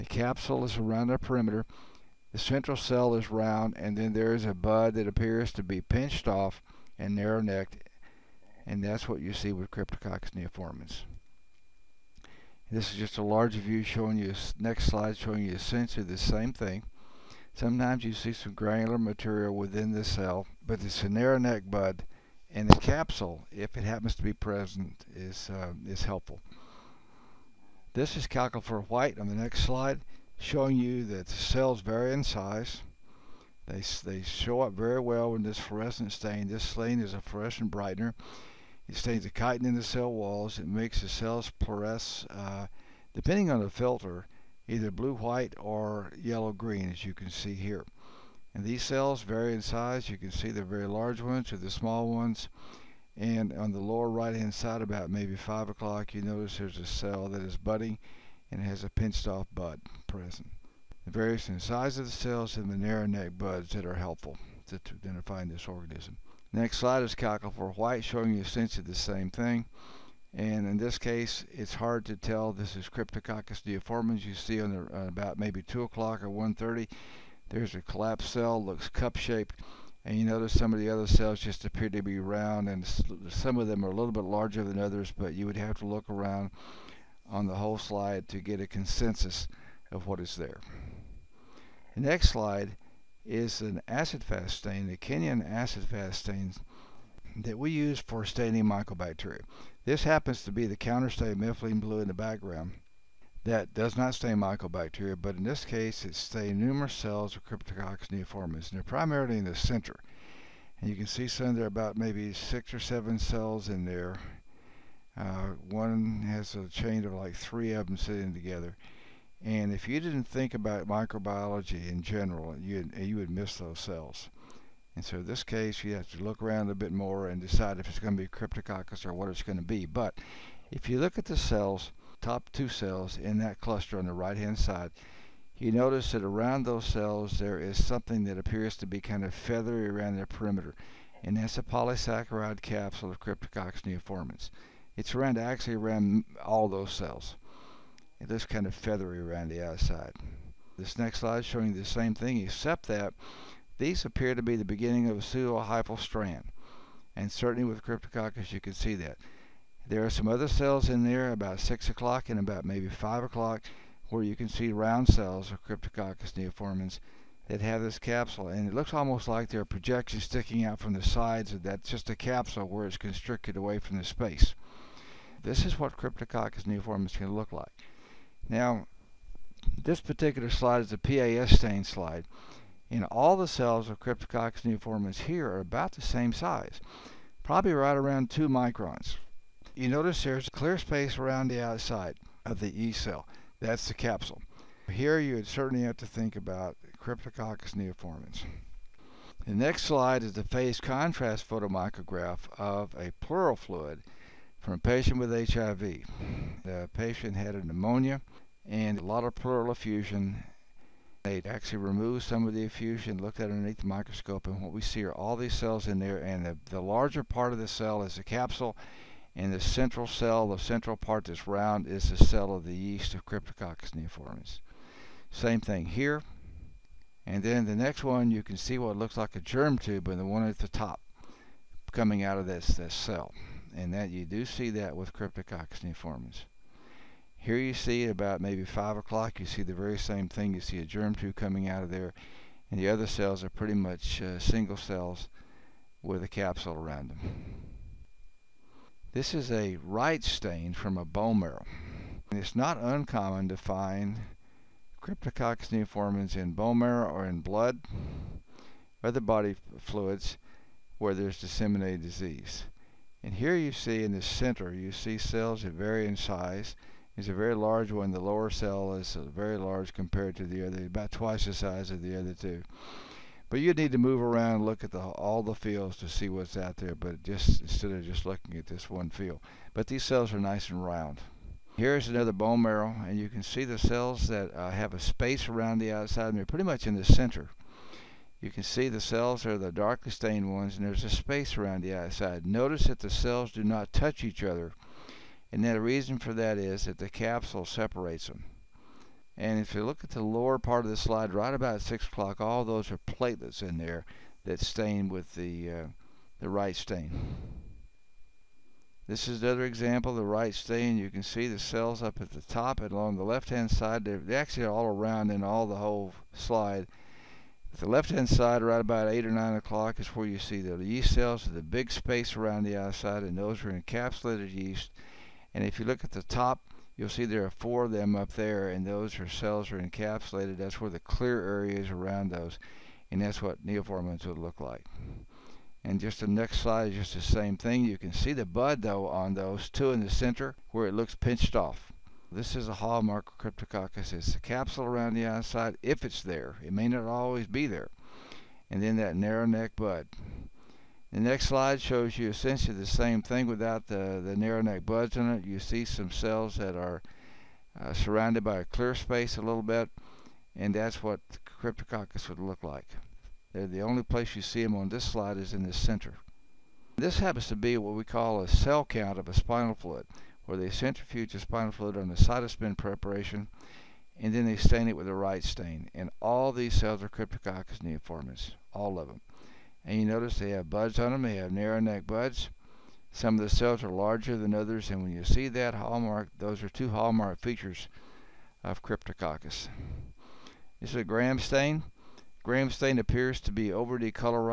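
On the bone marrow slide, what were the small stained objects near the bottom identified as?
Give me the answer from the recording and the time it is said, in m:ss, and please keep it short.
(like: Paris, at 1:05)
platelets, at 5:02.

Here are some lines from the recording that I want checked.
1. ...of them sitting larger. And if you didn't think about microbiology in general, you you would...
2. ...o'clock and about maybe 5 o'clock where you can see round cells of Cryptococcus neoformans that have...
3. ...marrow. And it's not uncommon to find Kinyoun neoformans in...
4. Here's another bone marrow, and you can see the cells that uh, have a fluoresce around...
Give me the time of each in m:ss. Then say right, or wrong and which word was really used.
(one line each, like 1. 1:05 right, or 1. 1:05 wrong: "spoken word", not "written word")
1. 1:57 wrong: "together", not "larger"
2. 2:41 right
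3. 4:11 wrong: "Cryptococcus", not "Kinyoun"
4. 4:41 wrong: "space", not "fluoresce".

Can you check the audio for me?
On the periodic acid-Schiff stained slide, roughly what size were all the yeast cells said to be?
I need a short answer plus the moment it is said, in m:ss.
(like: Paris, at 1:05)
2 microns, at 3:08.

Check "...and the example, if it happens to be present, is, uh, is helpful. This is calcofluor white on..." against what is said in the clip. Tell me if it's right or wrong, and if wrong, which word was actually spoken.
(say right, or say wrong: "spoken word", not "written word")
wrong: "capsule", not "example".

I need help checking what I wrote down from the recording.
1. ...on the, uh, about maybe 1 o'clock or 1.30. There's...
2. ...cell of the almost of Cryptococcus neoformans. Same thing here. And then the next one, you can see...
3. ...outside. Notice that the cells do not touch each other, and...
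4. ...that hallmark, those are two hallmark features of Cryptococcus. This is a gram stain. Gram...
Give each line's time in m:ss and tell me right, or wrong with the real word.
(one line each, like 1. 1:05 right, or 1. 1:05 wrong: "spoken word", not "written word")
1. 1:14 wrong: "2", not "1"
2. 3:42 wrong: "yeast", not "almost"
3. 4:51 right
4. 6:25 right.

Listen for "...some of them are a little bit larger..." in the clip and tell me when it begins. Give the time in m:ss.
1:23.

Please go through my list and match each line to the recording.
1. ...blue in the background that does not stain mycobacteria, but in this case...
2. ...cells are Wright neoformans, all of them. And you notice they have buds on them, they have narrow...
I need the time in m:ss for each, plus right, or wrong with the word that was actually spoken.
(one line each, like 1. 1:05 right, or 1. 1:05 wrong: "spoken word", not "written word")
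1. 1:41 right
2. 6:16 wrong: "Cryptococcus", not "Wright".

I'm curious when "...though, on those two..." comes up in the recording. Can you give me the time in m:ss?
5:38.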